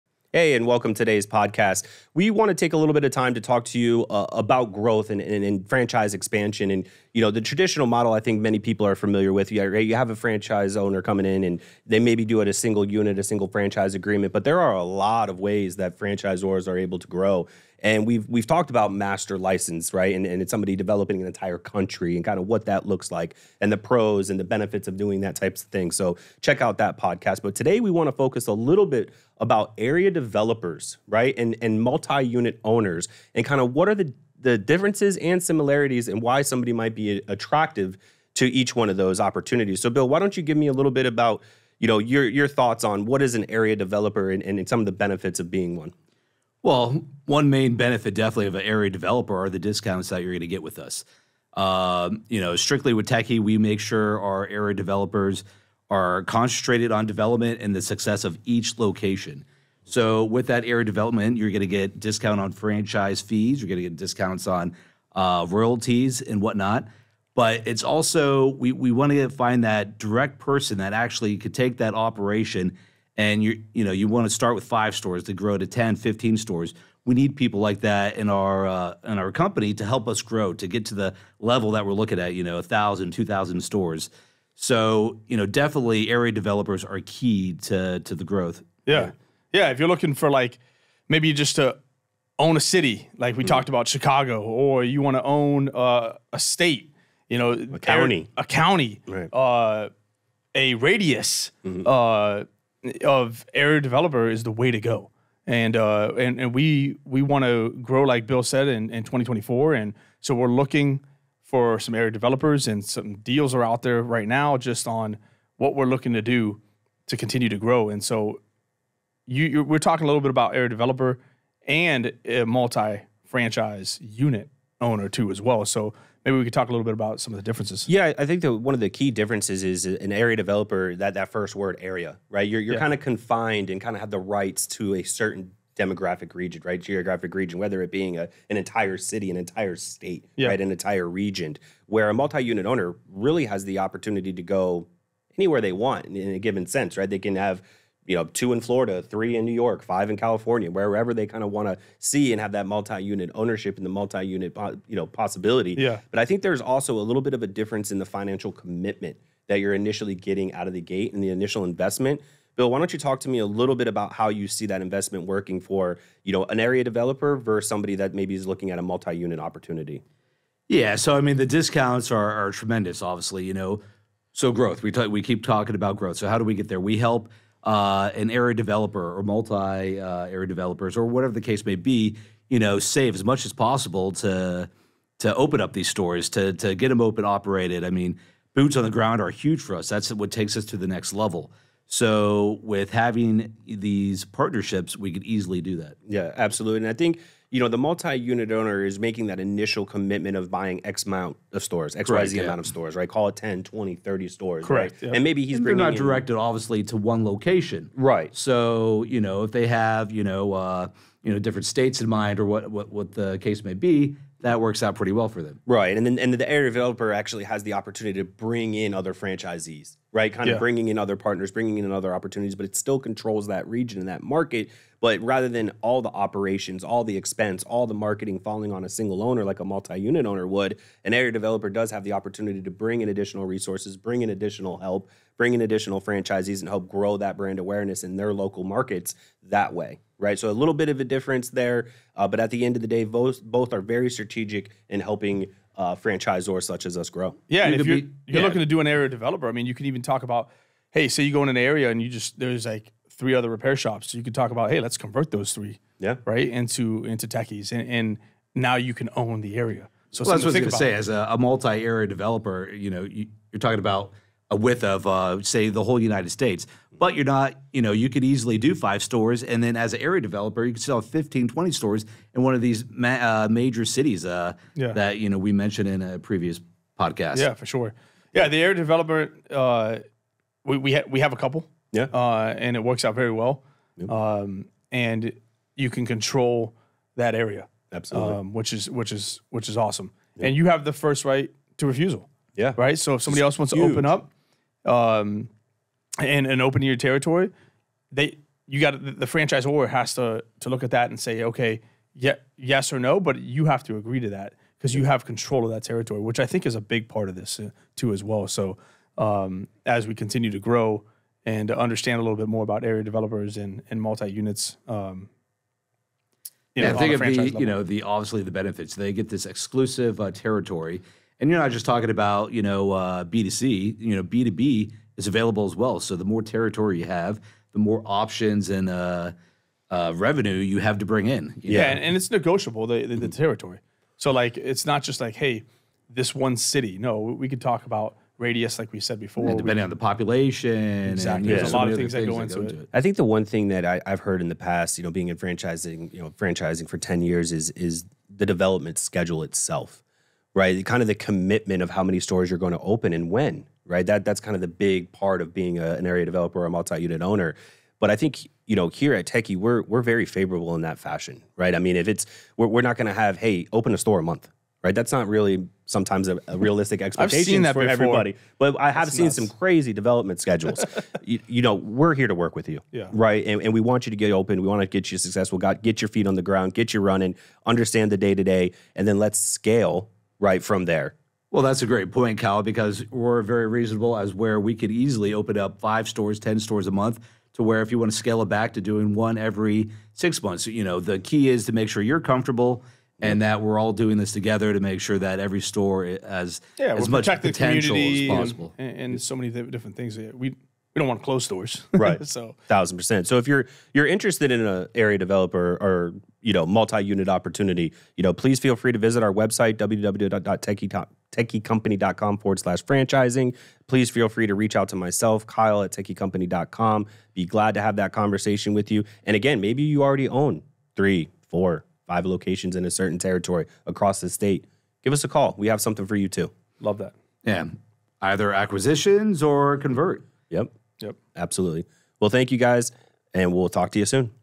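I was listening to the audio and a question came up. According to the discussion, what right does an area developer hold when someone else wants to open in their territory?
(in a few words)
First right to refusal.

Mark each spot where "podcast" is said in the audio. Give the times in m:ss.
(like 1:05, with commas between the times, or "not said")
0:01, 0:26, 4:36.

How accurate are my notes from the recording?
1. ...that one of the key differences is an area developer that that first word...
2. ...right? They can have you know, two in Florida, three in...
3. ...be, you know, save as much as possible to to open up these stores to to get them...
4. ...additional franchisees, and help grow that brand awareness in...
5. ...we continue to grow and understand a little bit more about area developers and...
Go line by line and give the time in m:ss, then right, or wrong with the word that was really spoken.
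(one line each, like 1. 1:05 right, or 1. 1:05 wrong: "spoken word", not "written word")
1. 2:08 right
2. 2:26 right
3. 3:01 right
4. 3:55 right
5. 5:10 right.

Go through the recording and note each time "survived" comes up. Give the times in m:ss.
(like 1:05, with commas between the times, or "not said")
not said.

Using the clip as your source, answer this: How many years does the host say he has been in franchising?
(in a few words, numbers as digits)
10 years.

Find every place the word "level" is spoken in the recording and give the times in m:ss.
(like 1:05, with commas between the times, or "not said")
1:21, 3:11, 5:17.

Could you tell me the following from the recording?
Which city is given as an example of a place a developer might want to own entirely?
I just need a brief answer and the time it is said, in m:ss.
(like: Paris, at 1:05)
Chicago, at 1:33.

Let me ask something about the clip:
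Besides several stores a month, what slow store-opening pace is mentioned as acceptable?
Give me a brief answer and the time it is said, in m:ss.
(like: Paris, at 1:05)
one every six months, at 6:29.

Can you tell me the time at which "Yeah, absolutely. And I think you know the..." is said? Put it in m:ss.
3:16.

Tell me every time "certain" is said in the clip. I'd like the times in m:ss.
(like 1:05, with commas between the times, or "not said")
2:15, 7:02.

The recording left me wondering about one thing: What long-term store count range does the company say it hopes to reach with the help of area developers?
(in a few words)
1000 2000 stores.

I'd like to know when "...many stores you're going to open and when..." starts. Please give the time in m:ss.
5:52.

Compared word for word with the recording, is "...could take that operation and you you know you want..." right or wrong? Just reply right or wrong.
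right.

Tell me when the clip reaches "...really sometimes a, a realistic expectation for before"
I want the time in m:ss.
6:05.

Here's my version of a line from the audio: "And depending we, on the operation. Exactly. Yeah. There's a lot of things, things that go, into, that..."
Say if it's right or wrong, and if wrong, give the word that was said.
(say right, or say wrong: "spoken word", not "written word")
wrong: "population", not "operation".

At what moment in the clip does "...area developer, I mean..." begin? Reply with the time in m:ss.
4:08.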